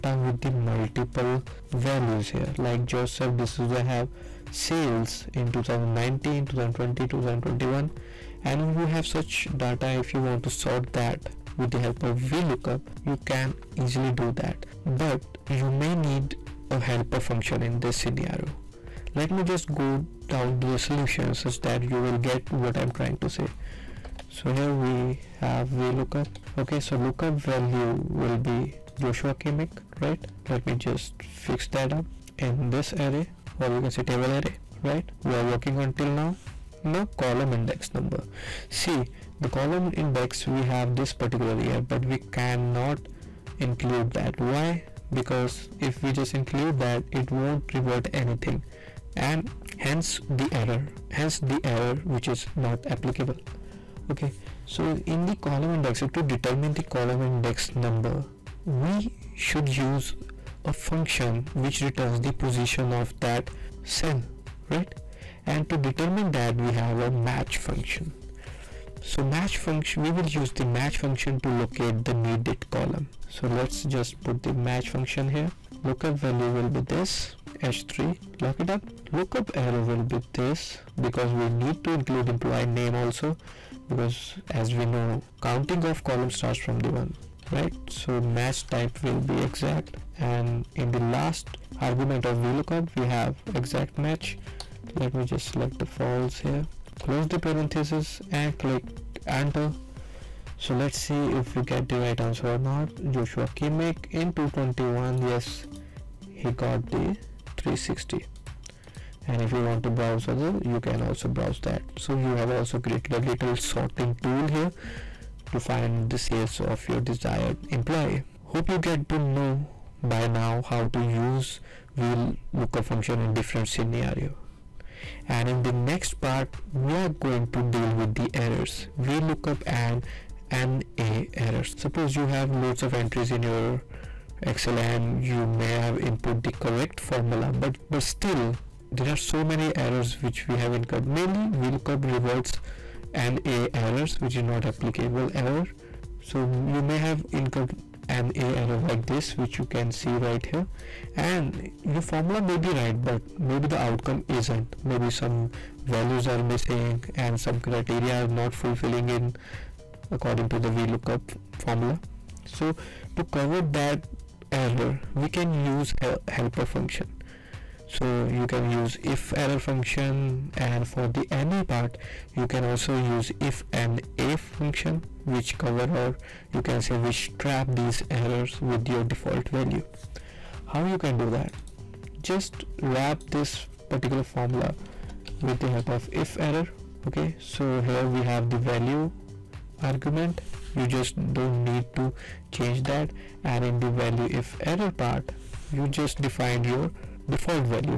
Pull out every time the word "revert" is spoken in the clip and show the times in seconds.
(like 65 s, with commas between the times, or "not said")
47 s, 142 s.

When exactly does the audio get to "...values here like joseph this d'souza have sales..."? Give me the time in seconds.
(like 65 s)
1 s.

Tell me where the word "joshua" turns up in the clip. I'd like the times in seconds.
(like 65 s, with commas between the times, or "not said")
28 s, 103 s.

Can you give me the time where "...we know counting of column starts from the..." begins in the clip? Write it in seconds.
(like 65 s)
84 s.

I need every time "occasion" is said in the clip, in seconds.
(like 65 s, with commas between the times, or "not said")
not said.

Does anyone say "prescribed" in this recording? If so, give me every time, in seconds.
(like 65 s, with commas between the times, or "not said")
not said.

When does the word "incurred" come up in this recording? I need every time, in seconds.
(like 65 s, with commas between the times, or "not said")
140 s, 147 s.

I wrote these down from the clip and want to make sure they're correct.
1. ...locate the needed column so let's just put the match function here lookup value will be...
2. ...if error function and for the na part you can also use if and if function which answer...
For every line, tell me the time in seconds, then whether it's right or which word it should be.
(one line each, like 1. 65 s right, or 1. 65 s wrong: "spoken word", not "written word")
1. 71 s right
2. 169 s wrong: "cover", not "answer".